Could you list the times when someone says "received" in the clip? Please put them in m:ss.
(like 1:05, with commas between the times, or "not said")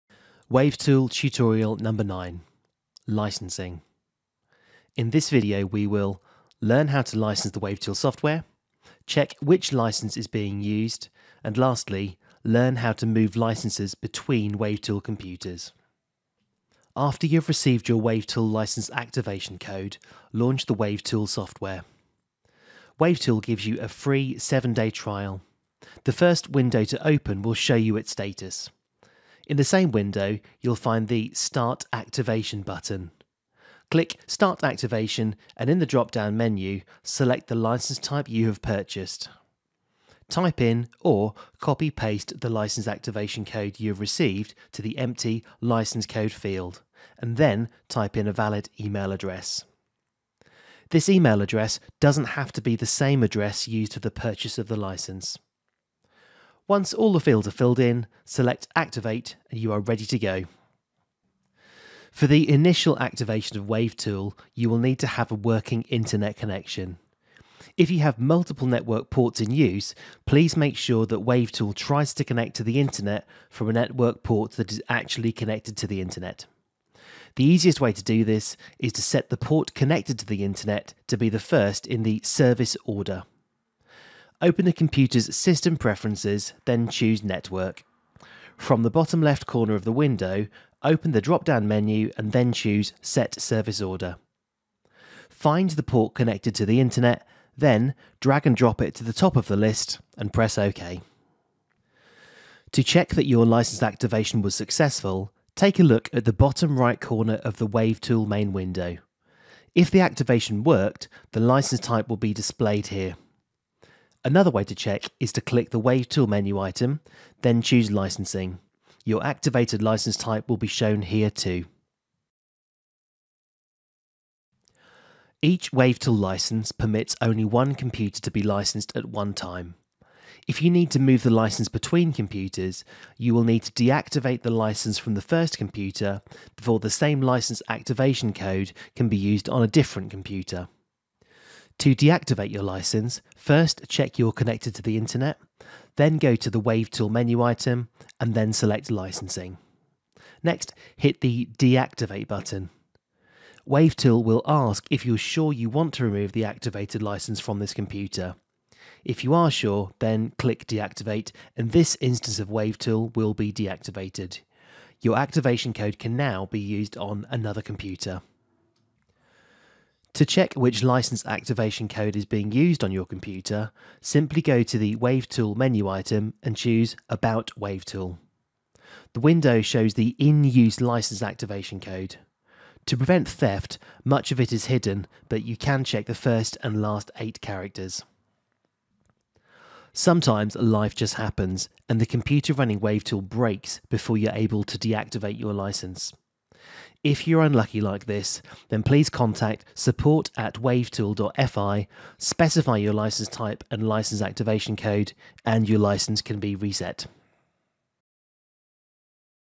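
0:17, 0:43.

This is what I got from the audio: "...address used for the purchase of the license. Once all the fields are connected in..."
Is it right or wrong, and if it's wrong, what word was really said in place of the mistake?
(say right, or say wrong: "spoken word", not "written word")
wrong: "filled", not "connected".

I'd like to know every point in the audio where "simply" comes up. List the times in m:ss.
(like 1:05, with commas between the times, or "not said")
2:54.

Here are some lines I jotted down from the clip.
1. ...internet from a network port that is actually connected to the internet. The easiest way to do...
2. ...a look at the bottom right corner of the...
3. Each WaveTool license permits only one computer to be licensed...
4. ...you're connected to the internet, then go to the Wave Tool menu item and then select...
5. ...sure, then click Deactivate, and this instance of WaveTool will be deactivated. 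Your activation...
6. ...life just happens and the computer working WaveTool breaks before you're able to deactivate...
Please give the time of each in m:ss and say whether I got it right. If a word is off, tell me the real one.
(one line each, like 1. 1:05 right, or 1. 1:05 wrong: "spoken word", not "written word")
1. 1:12 right
2. 1:45 right
3. 2:05 right
4. 2:24 right
5. 2:39 right
6. 3:10 wrong: "running", not "working".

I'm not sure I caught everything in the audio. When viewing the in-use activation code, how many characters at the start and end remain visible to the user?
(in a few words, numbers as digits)
8.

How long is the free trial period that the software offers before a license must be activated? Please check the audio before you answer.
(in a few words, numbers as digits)
7 days.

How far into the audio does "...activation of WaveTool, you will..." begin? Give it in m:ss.
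1:02.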